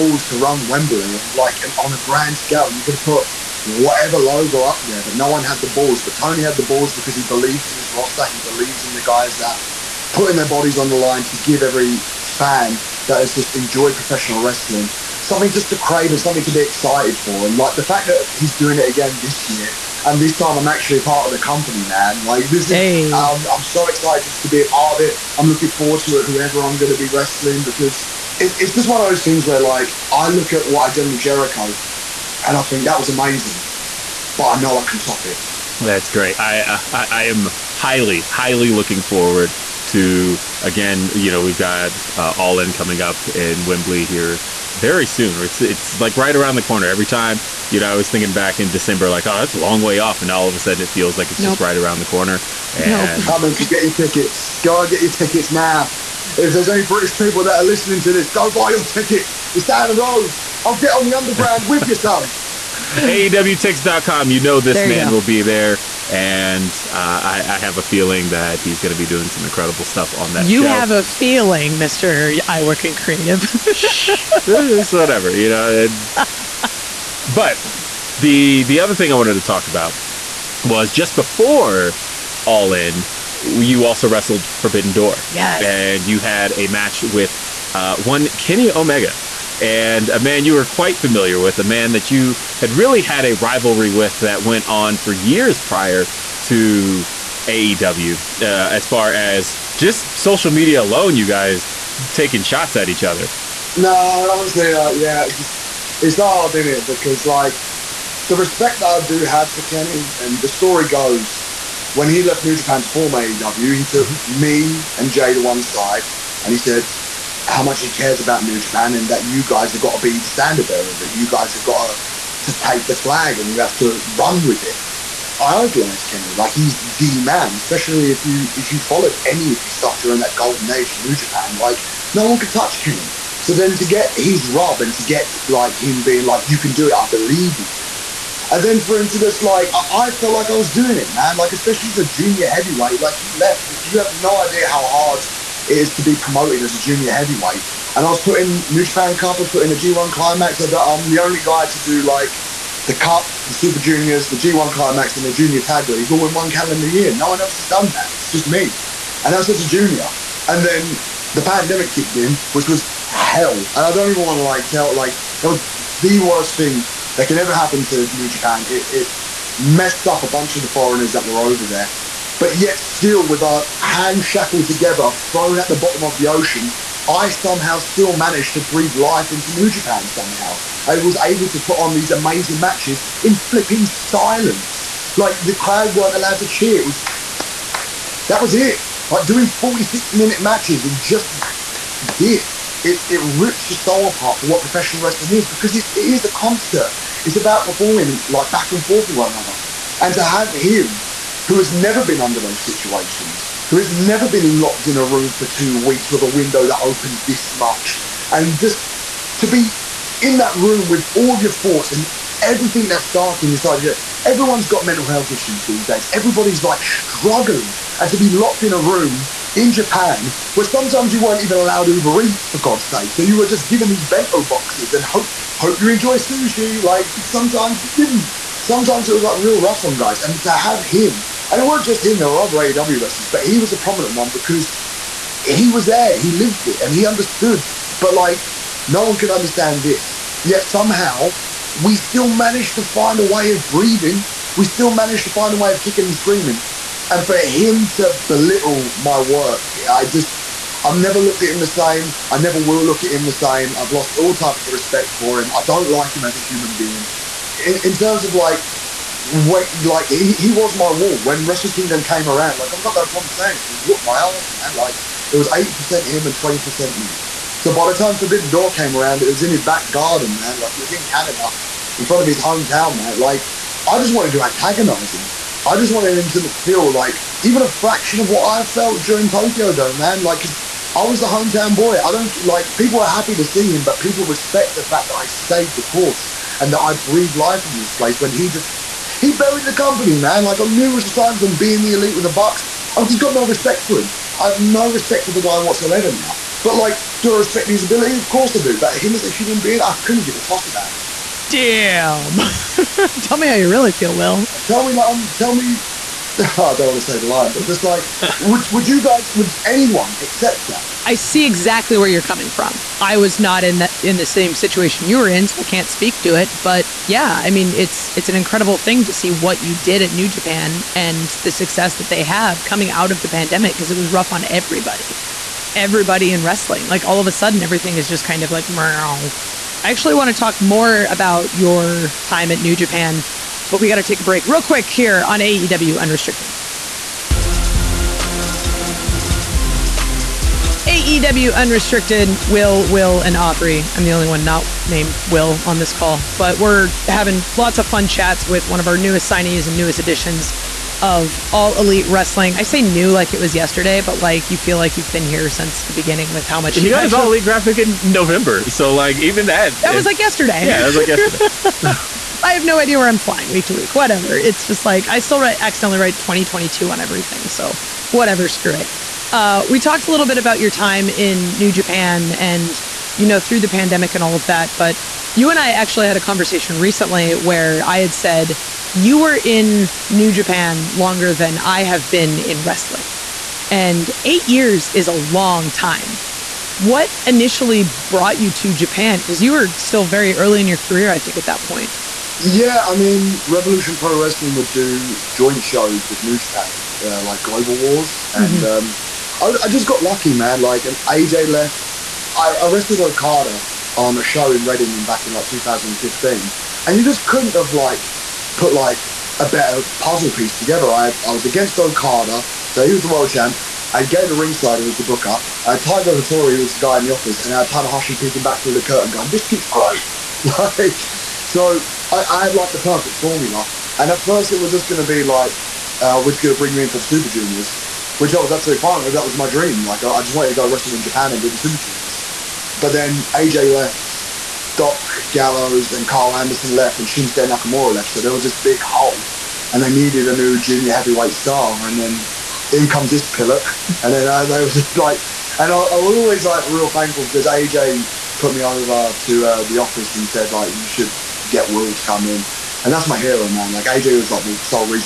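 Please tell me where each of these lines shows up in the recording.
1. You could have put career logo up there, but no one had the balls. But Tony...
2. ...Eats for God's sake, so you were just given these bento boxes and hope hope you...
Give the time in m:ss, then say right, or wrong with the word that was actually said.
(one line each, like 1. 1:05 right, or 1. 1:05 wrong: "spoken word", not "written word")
1. 0:02 wrong: "whatever", not "career"
2. 3:42 right.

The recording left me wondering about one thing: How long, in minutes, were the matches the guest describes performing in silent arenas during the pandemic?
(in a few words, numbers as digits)
46.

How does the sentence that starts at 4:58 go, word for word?
But him as a human being, I couldn't give a toss about him anymore.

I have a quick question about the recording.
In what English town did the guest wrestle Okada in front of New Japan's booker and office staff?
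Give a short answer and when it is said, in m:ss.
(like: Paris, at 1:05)
Reading, at 6:44.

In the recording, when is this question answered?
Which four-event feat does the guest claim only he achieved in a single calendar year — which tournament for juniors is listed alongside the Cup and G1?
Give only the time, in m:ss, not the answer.
2:35.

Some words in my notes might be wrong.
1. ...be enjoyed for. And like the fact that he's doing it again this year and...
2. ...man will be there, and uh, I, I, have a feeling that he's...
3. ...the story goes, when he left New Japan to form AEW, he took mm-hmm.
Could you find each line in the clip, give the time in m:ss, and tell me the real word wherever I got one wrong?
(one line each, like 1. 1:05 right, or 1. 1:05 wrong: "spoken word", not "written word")
1. 0:16 wrong: "excited", not "enjoyed"
2. 1:04 right
3. 1:50 right.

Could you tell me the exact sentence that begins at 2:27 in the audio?
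And I was put in New Japan Cup, I was put in a G1 Climax.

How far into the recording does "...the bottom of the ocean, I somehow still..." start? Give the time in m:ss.
2:55.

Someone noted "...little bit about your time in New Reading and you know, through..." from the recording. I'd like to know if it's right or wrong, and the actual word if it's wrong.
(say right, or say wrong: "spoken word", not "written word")
wrong: "Japan", not "Reading".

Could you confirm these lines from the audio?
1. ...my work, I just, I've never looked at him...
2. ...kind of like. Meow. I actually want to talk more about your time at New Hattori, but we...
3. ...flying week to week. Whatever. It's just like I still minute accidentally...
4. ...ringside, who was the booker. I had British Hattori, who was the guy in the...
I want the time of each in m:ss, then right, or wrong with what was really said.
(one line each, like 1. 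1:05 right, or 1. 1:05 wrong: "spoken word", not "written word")
1. 4:08 right
2. 5:28 wrong: "Japan", not "Hattori"
3. 6:03 wrong: "write", not "minute"
4. 6:54 wrong: "Tiger", not "British".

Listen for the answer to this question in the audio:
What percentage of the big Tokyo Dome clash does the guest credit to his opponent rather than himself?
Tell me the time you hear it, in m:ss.
4:25.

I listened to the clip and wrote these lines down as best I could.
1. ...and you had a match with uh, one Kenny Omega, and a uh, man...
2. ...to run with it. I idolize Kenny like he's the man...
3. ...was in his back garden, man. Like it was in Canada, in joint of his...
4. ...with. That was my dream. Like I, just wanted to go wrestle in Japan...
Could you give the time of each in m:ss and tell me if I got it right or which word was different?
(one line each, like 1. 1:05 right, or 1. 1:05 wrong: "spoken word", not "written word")
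1. 1:25 right
2. 2:03 right
3. 4:29 wrong: "front", not "joint"
4. 7:09 right.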